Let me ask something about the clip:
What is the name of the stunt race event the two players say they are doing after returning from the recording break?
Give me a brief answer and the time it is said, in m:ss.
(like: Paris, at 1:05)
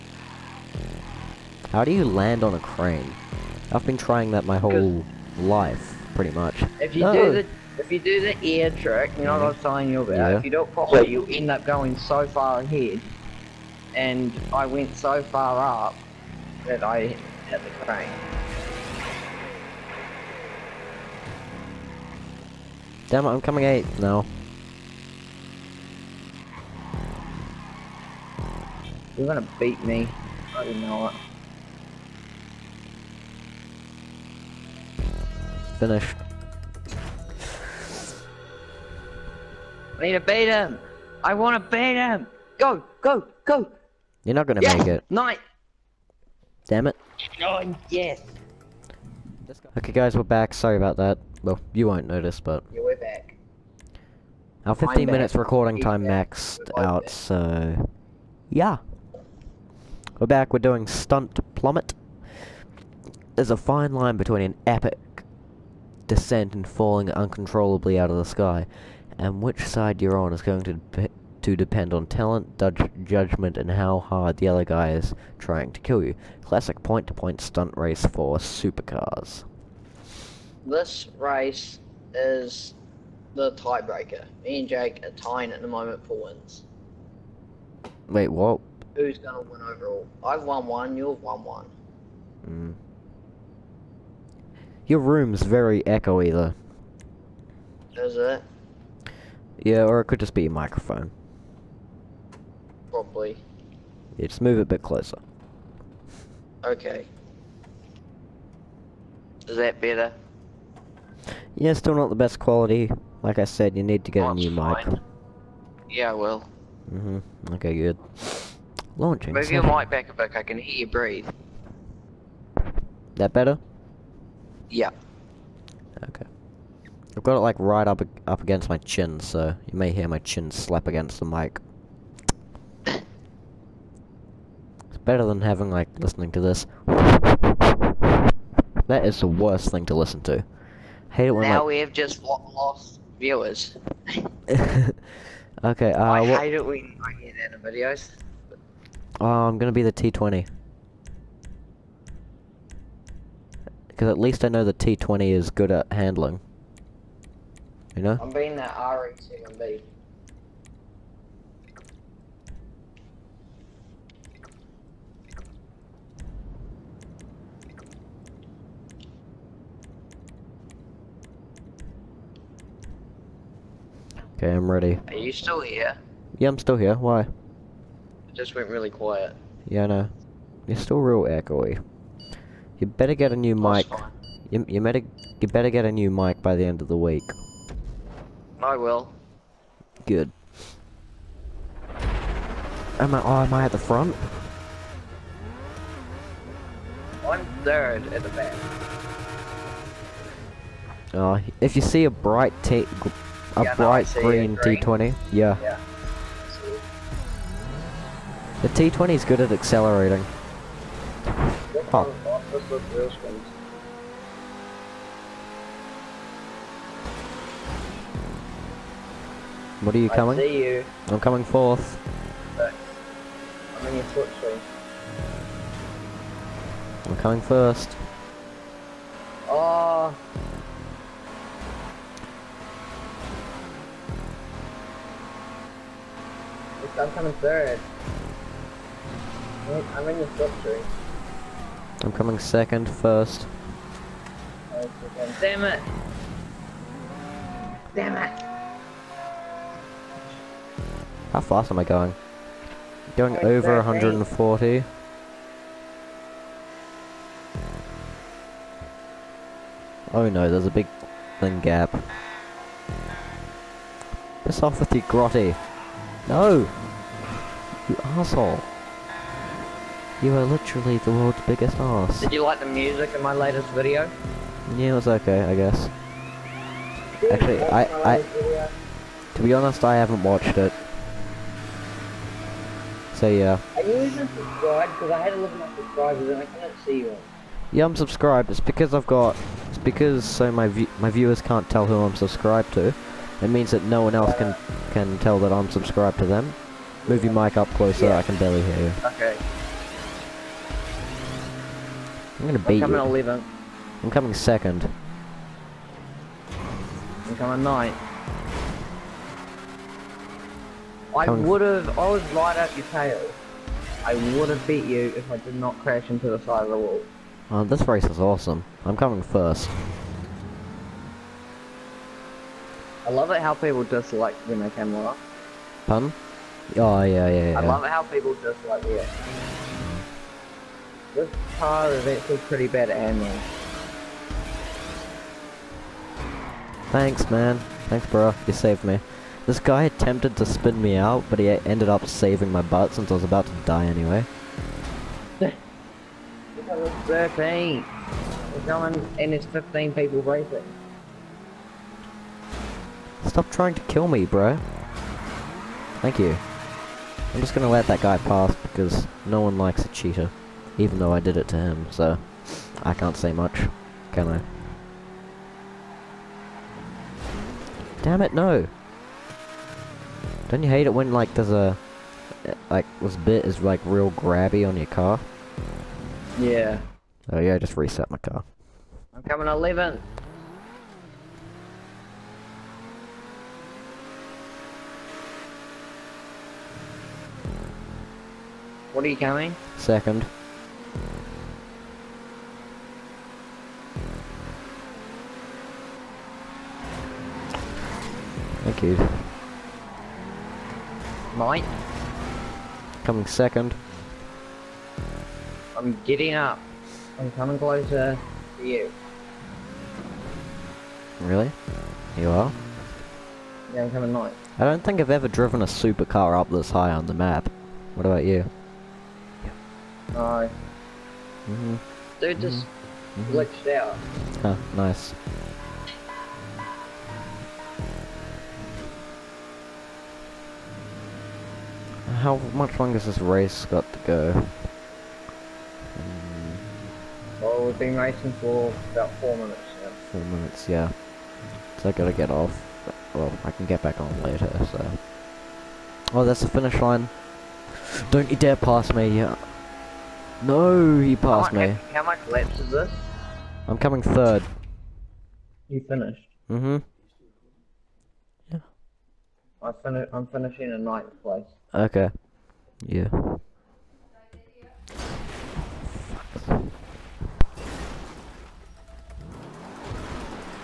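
Stunt Plummet, at 1:00.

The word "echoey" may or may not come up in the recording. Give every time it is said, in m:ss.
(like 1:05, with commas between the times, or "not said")
1:35, 3:01.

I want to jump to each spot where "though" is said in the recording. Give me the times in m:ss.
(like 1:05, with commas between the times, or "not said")
1:36, 6:00.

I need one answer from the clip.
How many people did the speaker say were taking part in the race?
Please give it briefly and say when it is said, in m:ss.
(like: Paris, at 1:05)
15, at 5:49.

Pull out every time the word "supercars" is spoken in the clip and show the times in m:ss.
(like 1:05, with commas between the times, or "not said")
1:18, 6:55.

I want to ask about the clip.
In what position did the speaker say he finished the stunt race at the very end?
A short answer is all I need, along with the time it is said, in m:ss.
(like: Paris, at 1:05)
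9th, at 7:40.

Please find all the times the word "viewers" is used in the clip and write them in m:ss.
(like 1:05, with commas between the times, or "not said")
2:23, 4:51.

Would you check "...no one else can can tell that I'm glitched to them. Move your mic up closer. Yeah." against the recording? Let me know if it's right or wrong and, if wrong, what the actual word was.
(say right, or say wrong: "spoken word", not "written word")
wrong: "subscribed", not "glitched".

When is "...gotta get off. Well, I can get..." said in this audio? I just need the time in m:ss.
7:21.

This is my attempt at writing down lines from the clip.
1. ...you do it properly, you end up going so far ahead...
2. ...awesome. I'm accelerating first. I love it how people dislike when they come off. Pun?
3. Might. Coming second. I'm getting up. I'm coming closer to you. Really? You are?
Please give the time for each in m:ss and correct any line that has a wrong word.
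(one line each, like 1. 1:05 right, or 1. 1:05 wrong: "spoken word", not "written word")
1. 0:10 right
2. 5:18 wrong: "coming", not "accelerating"
3. 6:41 right.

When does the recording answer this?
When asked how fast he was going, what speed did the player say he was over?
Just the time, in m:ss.
4:13.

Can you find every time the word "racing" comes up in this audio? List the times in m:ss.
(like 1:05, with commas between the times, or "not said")
5:50, 7:17.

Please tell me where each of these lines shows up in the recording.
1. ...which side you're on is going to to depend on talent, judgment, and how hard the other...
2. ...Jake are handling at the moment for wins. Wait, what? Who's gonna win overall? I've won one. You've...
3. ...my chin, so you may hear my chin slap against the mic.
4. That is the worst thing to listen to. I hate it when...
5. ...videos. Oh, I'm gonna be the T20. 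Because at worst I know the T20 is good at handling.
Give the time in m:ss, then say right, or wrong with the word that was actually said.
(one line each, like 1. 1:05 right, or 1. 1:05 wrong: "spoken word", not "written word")
1. 1:09 right
2. 1:24 wrong: "tying", not "handling"
3. 2:08 right
4. 2:18 right
5. 2:27 wrong: "least", not "worst".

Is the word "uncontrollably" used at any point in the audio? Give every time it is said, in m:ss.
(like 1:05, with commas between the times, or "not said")
1:07.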